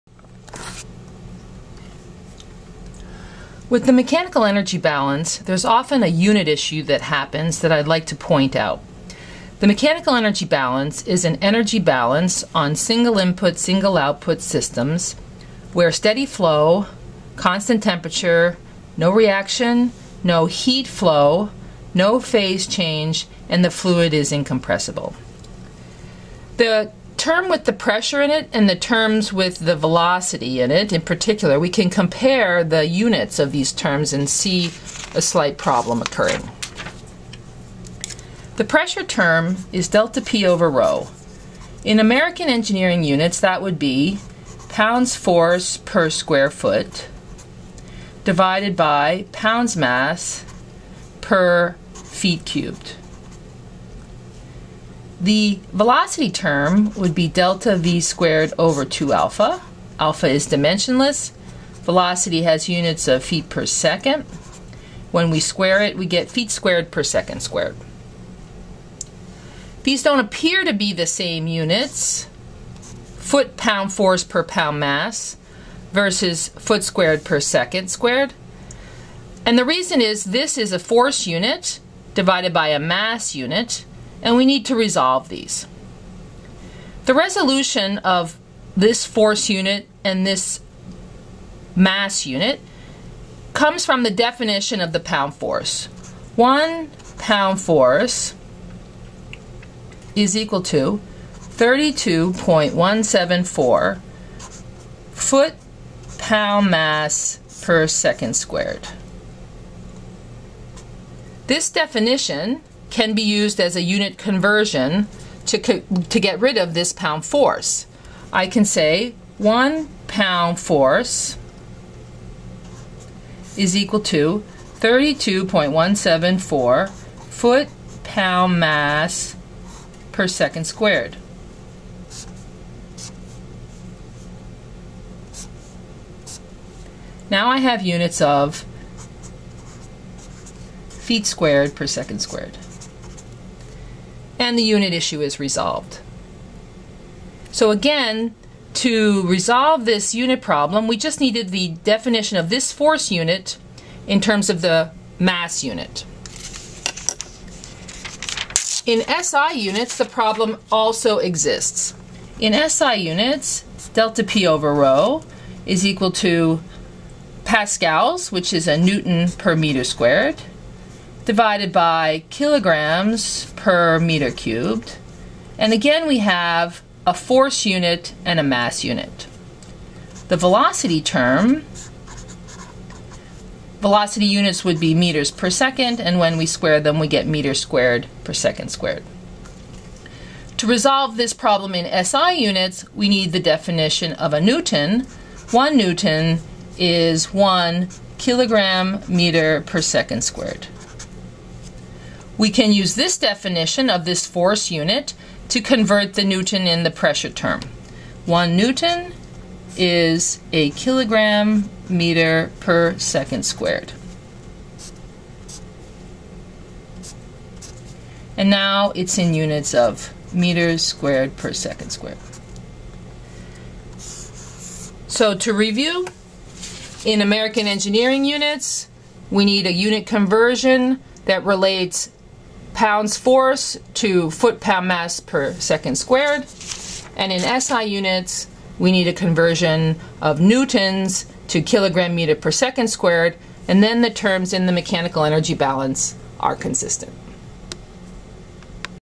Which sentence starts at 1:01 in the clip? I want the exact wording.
Velocity has units of feet per second.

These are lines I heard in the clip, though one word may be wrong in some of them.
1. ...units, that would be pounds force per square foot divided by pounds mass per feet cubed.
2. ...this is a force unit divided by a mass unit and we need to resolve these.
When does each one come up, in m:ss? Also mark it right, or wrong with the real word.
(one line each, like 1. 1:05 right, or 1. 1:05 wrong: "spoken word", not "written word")
1. 0:43 right
2. 1:20 right.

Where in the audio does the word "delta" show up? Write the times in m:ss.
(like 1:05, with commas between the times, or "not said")
0:39, 0:57, 2:43.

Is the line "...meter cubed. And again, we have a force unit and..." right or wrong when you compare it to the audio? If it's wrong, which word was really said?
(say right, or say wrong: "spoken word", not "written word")
right.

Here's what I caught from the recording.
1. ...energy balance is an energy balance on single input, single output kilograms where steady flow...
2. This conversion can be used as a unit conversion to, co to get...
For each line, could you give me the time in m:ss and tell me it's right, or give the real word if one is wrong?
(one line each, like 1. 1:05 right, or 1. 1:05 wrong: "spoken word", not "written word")
1. 0:10 wrong: "systems", not "kilograms"
2. 1:51 wrong: "definition", not "conversion".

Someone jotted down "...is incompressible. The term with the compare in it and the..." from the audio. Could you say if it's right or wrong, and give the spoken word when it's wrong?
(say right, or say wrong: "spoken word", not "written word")
wrong: "pressure", not "compare".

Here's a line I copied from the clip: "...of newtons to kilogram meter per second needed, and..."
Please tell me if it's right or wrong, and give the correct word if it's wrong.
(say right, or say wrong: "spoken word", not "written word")
wrong: "squared", not "needed".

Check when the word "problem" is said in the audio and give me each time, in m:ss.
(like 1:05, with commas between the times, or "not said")
0:35, 2:30, 2:40, 3:11.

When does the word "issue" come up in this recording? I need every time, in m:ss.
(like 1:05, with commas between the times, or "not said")
0:06, 2:24.